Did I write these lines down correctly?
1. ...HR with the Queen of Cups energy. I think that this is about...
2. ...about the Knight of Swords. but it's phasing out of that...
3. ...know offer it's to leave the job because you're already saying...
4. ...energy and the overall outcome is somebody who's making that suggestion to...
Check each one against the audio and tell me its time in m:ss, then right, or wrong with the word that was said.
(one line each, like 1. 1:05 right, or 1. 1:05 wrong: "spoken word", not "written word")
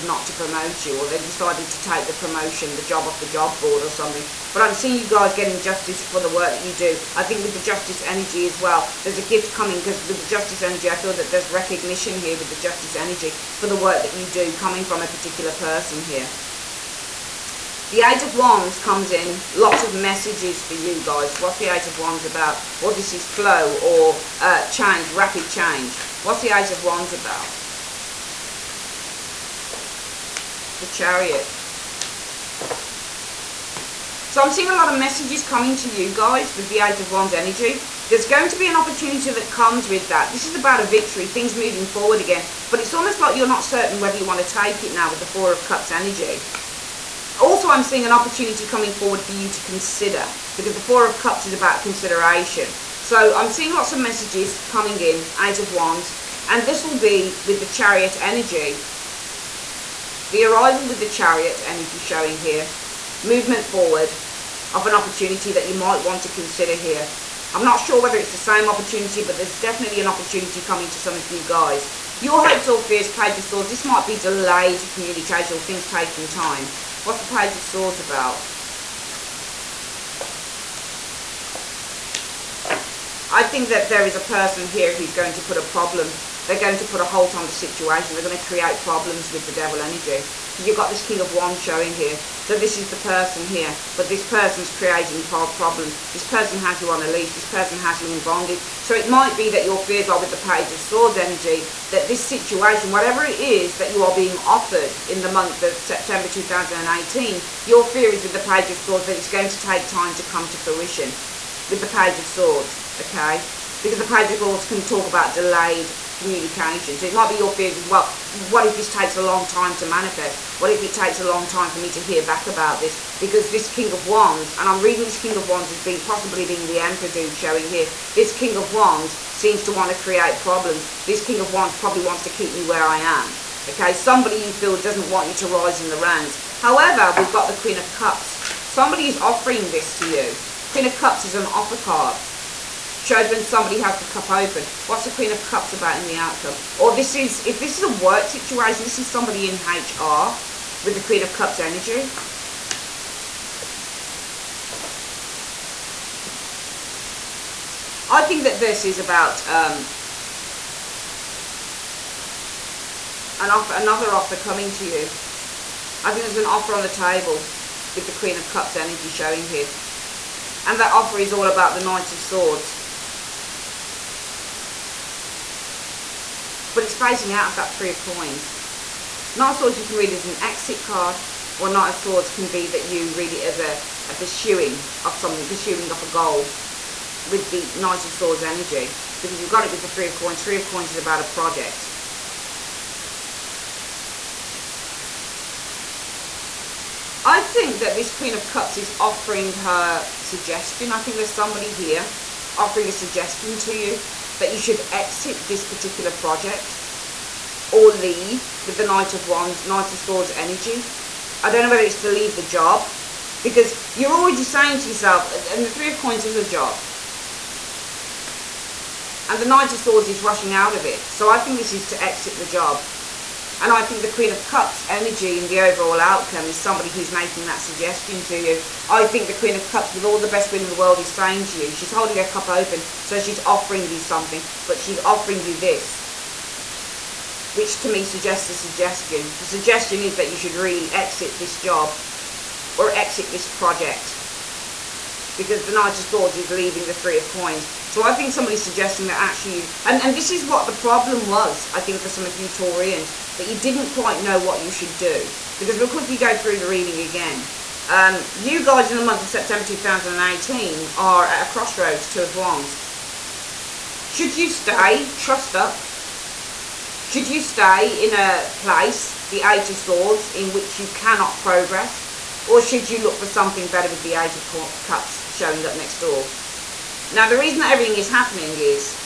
1. 2:29 right
2. 2:51 right
3. 3:31 wrong: "whether", not "offer"
4. 3:44 right.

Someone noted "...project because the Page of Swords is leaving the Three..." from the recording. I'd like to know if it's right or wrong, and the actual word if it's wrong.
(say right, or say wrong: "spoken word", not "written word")
wrong: "Knight", not "Page".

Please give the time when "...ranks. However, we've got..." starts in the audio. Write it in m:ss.
2:15.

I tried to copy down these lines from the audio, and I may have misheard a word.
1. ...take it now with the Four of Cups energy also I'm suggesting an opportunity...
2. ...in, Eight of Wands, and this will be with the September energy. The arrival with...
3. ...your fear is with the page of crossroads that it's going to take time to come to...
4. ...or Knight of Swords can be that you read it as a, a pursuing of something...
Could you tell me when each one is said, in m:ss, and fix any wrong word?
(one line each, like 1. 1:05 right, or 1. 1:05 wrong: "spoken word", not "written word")
1. 0:44 wrong: "seeing", not "suggesting"
2. 0:54 wrong: "Chariot", not "September"
3. 1:47 wrong: "swords", not "crossroads"
4. 3:01 right.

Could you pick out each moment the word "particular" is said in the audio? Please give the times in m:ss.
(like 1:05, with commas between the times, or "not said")
0:15, 3:25.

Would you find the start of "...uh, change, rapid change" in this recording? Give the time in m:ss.
0:24.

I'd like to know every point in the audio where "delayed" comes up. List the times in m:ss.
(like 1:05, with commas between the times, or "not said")
1:14, 1:55.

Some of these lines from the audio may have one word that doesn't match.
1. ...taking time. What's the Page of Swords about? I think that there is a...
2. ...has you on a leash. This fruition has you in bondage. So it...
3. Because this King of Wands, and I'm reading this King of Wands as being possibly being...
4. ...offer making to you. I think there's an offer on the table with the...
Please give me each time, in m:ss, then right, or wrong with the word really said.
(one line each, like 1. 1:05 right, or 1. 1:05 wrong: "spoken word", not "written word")
1. 1:15 right
2. 1:36 wrong: "person", not "fruition"
3. 2:03 right
4. 2:44 wrong: "coming", not "making".